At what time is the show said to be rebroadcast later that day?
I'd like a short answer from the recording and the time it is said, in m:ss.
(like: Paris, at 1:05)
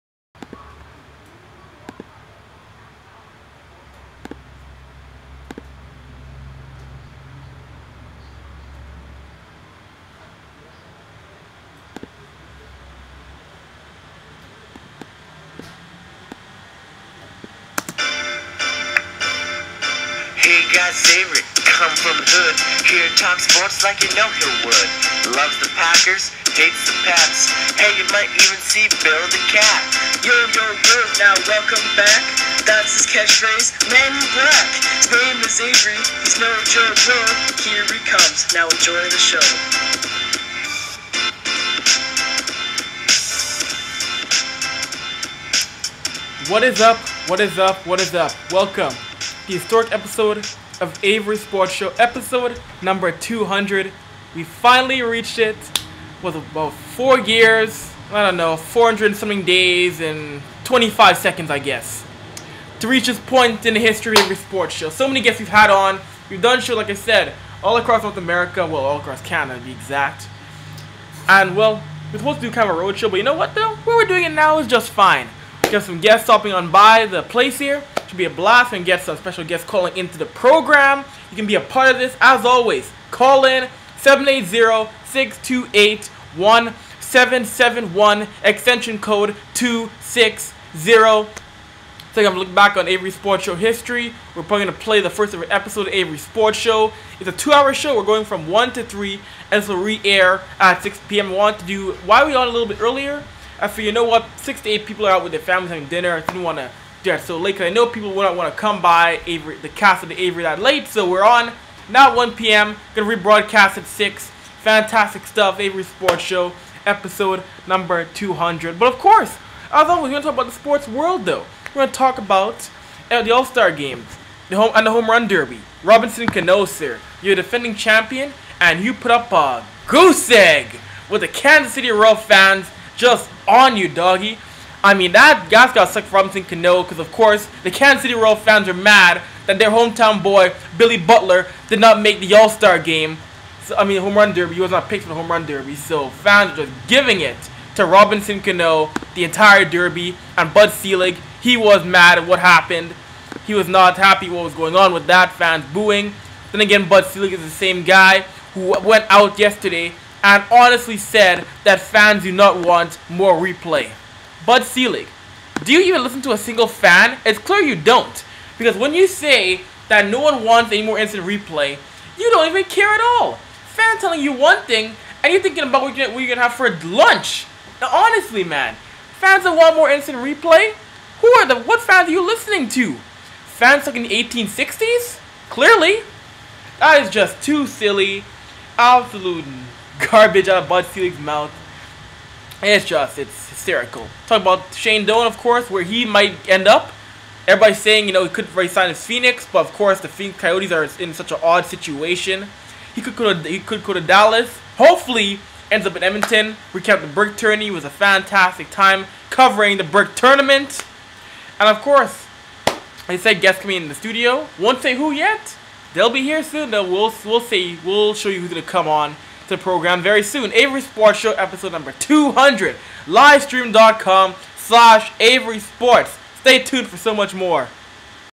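6 p.m., at 1:40.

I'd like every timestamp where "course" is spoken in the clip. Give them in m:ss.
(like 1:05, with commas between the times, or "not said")
1:58, 2:17, 3:15, 3:19, 3:31.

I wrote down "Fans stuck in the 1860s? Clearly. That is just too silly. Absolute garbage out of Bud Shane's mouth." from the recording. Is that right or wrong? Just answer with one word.
wrong.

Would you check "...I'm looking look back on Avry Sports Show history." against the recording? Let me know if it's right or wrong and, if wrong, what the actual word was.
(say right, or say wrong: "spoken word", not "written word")
right.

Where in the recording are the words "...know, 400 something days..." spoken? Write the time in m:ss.
0:58.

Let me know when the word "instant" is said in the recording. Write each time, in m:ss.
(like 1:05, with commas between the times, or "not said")
2:50, 2:59.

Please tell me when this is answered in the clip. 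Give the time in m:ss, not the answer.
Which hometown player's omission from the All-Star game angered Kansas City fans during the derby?
2:20.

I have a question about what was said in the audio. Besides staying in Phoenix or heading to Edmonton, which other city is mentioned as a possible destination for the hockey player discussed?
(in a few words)
Dallas.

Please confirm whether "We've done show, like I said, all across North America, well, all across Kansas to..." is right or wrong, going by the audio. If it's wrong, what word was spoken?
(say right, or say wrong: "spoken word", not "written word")
wrong: "Canada", not "Kansas".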